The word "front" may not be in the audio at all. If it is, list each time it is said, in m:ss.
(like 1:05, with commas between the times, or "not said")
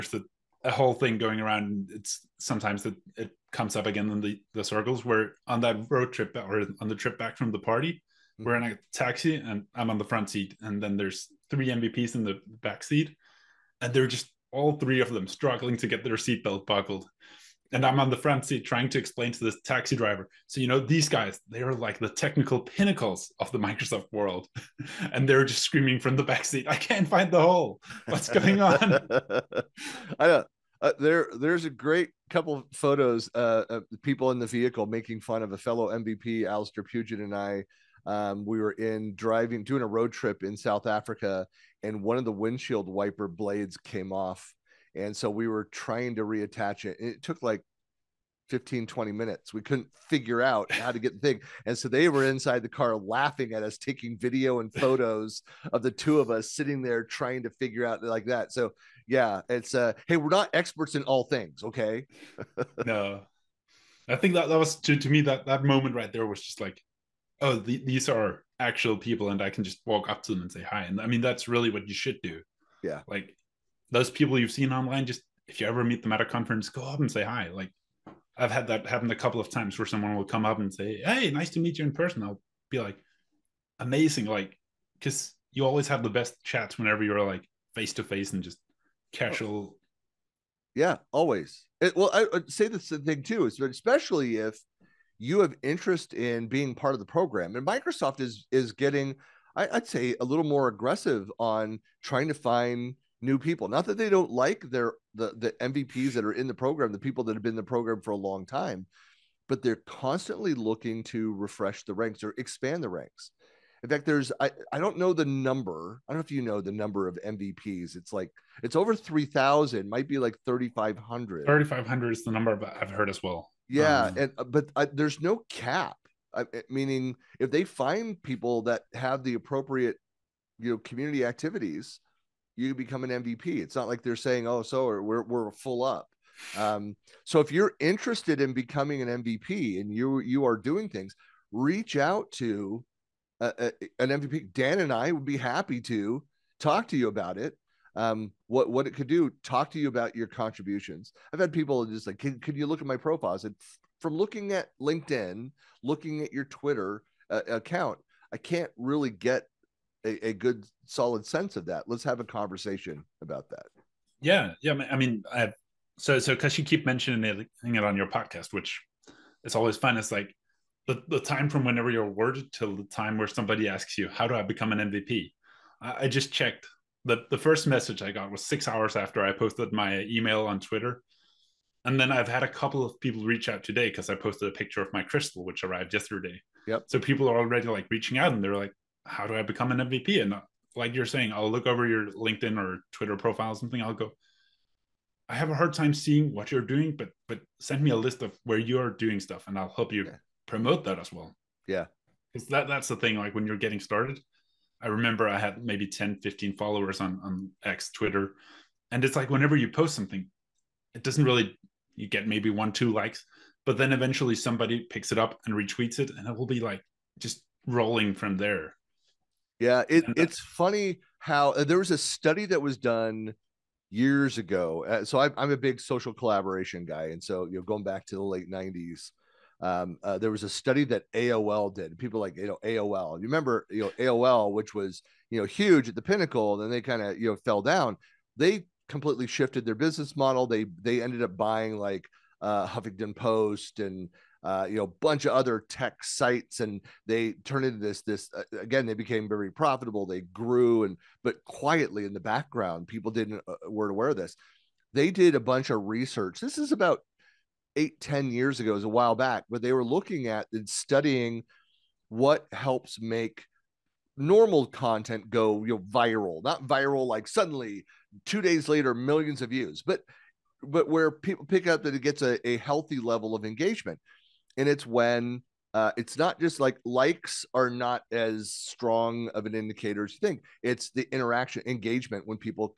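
0:10, 0:18.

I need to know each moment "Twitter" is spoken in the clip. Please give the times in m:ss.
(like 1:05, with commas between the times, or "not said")
2:36, 3:00, 3:12, 3:27.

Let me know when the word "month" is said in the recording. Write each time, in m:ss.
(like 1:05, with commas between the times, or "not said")
not said.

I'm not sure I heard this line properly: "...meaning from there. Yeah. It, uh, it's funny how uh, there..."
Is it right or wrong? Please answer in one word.
wrong.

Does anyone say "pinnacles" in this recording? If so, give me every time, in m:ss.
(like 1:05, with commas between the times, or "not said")
0:22, 3:56.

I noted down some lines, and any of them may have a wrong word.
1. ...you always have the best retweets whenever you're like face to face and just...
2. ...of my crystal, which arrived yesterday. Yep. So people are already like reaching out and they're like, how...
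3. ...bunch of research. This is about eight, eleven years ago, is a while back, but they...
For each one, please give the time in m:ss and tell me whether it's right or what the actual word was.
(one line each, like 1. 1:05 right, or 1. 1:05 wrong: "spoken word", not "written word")
1. 1:25 wrong: "chats", not "retweets"
2. 3:04 right
3. 4:15 wrong: "ten", not "eleven".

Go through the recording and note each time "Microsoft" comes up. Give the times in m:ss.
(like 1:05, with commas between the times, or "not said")
0:23, 1:37.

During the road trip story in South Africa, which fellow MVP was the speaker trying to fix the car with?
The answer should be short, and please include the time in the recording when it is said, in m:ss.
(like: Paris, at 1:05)
Alistair Pugin, at 0:36.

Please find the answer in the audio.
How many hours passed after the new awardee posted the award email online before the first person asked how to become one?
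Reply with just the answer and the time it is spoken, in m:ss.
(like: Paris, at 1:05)
6, at 2:58.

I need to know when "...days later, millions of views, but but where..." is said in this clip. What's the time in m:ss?
4:28.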